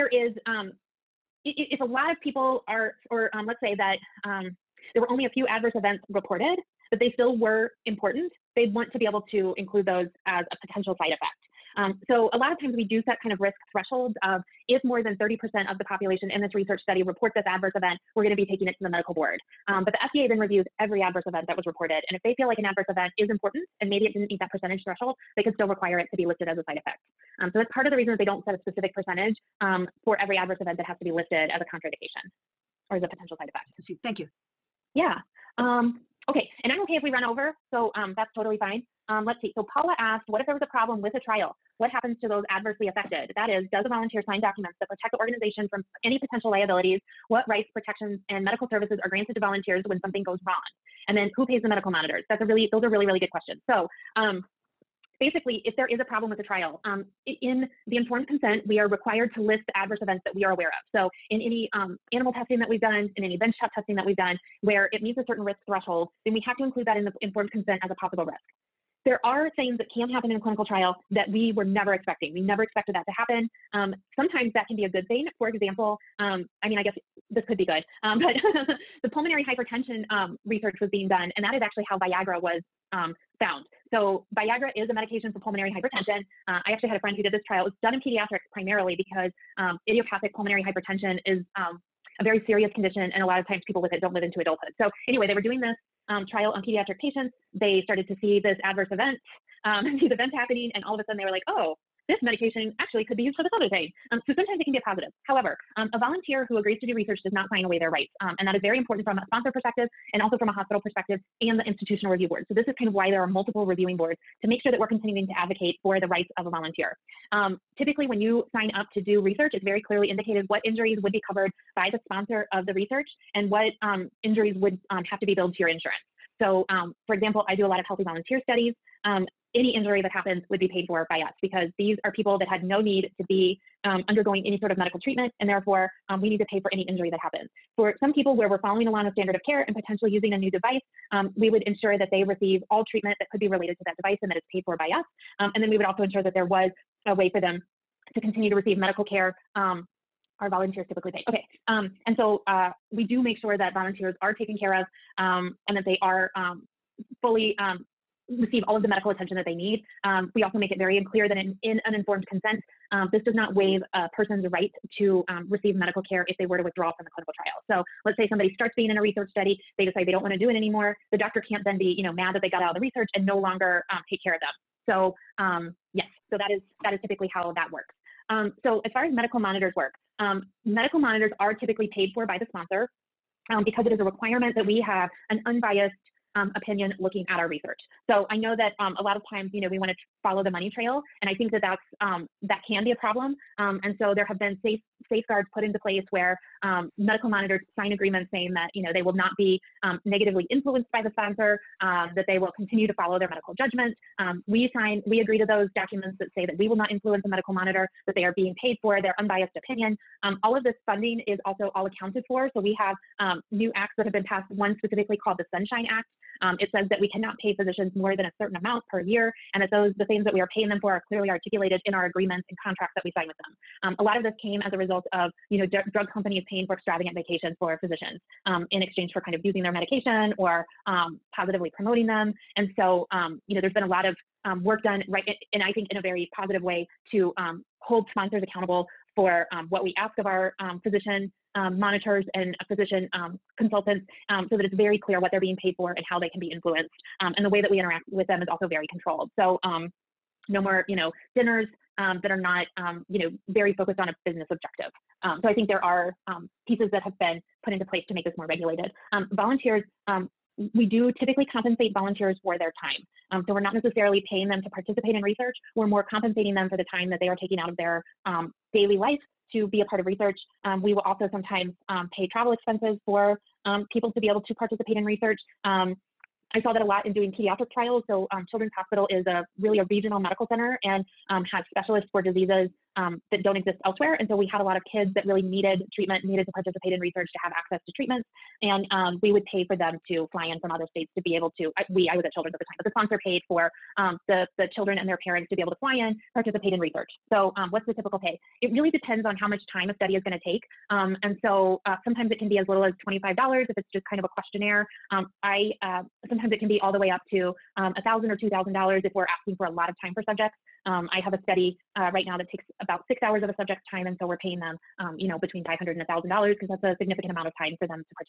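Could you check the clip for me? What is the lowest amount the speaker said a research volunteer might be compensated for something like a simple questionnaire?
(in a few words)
$25.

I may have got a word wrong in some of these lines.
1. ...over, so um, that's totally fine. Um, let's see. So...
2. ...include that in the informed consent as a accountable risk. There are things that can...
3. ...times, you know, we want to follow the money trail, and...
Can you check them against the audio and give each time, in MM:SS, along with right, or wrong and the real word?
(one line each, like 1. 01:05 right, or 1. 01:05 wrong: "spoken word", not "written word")
1. 00:37 right
2. 01:06 wrong: "possible", not "accountable"
3. 03:09 right.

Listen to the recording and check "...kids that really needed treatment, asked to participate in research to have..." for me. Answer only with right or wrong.
wrong.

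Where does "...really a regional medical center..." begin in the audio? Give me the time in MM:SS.
04:39.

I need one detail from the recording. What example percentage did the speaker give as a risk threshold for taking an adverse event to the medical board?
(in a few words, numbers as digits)
30%.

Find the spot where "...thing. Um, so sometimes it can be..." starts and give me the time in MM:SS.
01:43.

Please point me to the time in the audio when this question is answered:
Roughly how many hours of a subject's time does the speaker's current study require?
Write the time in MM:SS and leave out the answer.
05:13.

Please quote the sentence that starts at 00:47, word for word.
What rights, protections, and medical services are granted to volunteers when something goes wrong?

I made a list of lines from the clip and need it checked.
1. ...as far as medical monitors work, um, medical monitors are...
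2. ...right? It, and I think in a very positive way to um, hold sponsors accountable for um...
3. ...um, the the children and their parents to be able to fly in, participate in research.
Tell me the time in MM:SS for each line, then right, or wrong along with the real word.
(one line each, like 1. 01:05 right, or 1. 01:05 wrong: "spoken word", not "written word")
1. 02:58 right
2. 03:55 right
3. 04:53 right.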